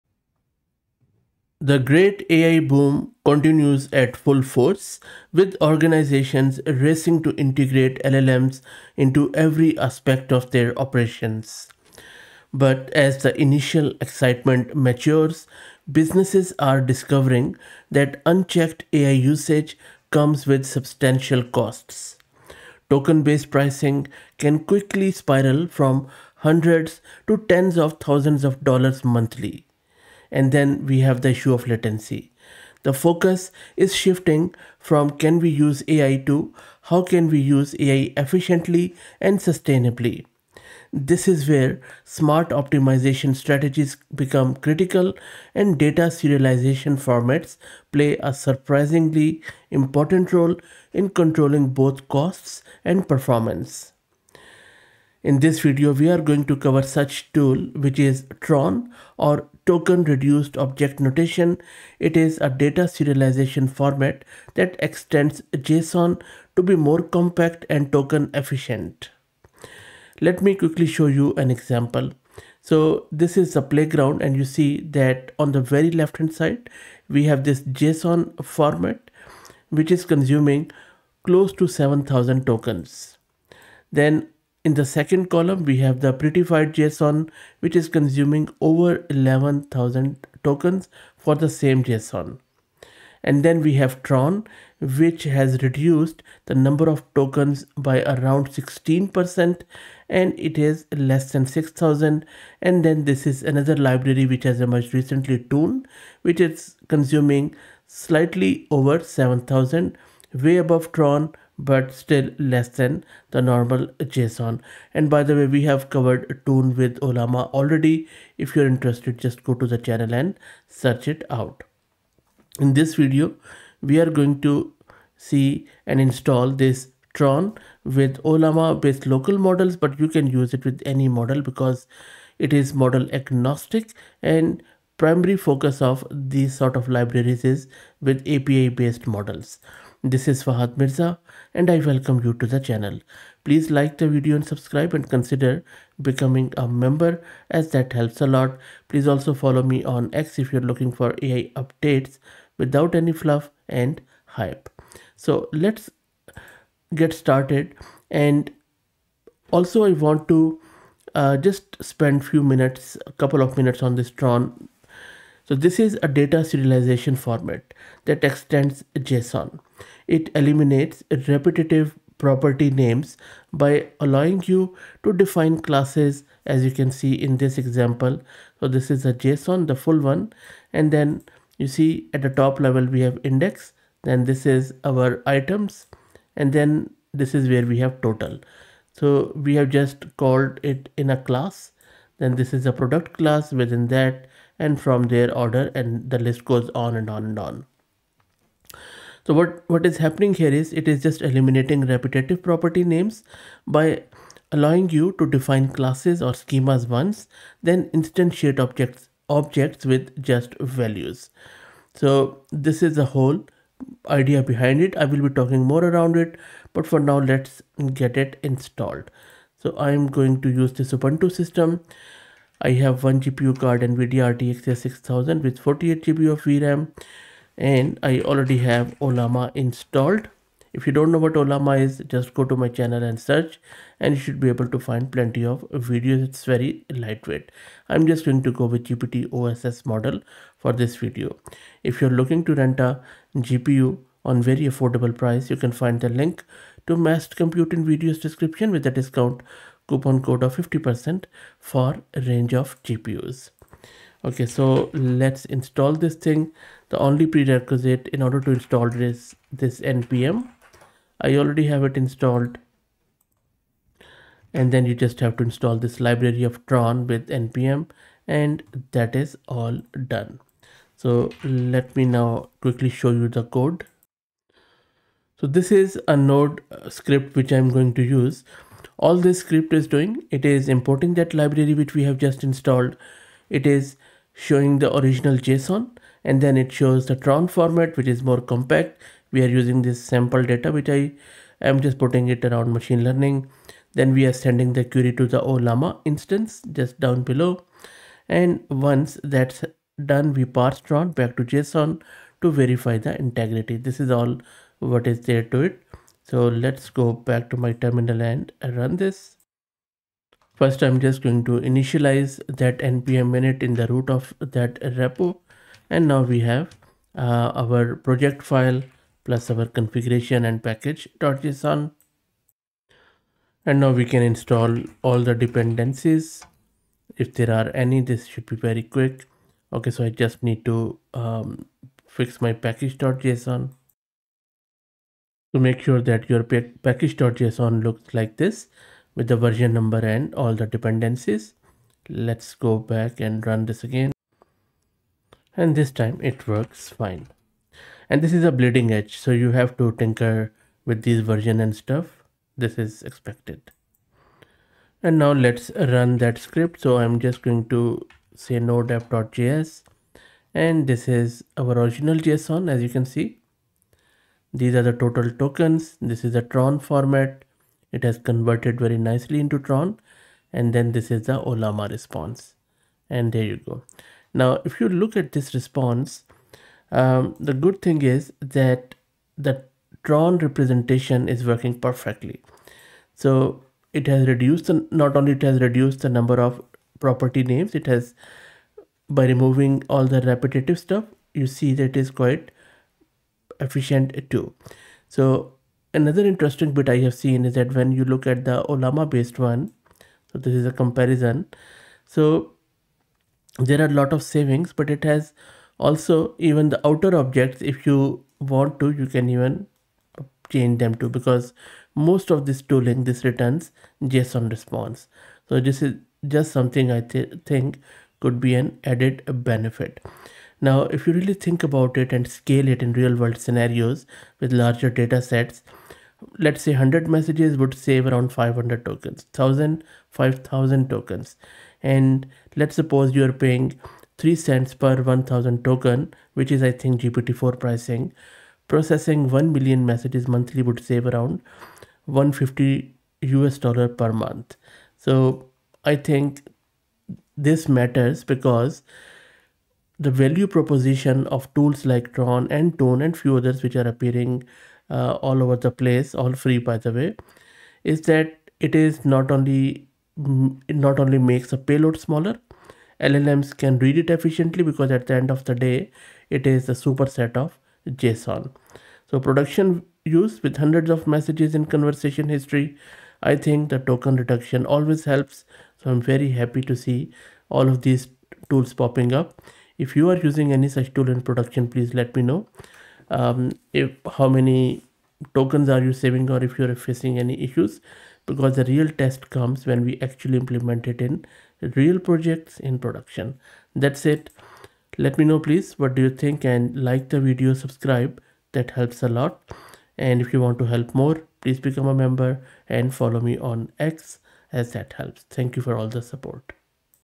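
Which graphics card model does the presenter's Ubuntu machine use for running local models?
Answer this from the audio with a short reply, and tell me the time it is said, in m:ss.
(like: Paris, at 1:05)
NVIDIA RTX 6000, at 3:43.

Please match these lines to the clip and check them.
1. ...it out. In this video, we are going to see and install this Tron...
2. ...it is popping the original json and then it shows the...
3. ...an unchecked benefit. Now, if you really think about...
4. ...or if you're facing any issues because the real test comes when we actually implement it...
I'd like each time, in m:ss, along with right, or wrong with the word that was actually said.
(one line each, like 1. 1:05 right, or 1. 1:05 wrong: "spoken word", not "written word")
1. 2:01 right
2. 4:43 wrong: "showing", not "popping"
3. 6:58 wrong: "added", not "unchecked"
4. 8:06 right.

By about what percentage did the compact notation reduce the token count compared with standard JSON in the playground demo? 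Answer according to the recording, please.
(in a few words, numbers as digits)
16%.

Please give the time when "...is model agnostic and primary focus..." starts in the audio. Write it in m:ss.
2:12.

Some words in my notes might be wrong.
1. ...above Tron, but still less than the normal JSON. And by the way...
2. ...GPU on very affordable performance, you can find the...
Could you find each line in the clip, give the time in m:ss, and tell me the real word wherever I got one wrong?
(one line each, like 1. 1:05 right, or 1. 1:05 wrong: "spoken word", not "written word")
1. 1:50 right
2. 4:03 wrong: "price", not "performance".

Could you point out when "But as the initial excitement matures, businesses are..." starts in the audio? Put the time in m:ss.
0:12.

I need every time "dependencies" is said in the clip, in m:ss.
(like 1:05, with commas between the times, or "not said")
5:25, 5:40.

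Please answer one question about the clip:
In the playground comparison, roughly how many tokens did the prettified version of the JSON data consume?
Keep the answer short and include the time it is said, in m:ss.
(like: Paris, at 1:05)
over 11,000, at 1:28.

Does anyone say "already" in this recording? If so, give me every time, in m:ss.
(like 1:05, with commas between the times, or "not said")
1:57, 3:48, 4:21.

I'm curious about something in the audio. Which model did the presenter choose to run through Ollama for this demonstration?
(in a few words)
GPT OSS.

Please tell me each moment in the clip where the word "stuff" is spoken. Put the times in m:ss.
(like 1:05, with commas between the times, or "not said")
5:51, 6:30.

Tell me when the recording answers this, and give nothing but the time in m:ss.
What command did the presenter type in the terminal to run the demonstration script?
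5:58.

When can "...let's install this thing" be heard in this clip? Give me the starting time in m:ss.
4:14.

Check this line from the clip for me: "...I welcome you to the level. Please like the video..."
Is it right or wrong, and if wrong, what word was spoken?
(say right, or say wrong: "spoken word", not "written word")
wrong: "channel", not "level".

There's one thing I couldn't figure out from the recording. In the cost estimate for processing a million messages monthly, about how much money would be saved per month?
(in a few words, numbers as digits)
$150.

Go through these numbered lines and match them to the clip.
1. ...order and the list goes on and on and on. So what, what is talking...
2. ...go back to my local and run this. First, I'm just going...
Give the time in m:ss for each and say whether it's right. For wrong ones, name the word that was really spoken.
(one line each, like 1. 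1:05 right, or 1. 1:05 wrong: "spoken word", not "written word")
1. 3:15 wrong: "happening", not "talking"
2. 5:06 wrong: "terminal", not "local".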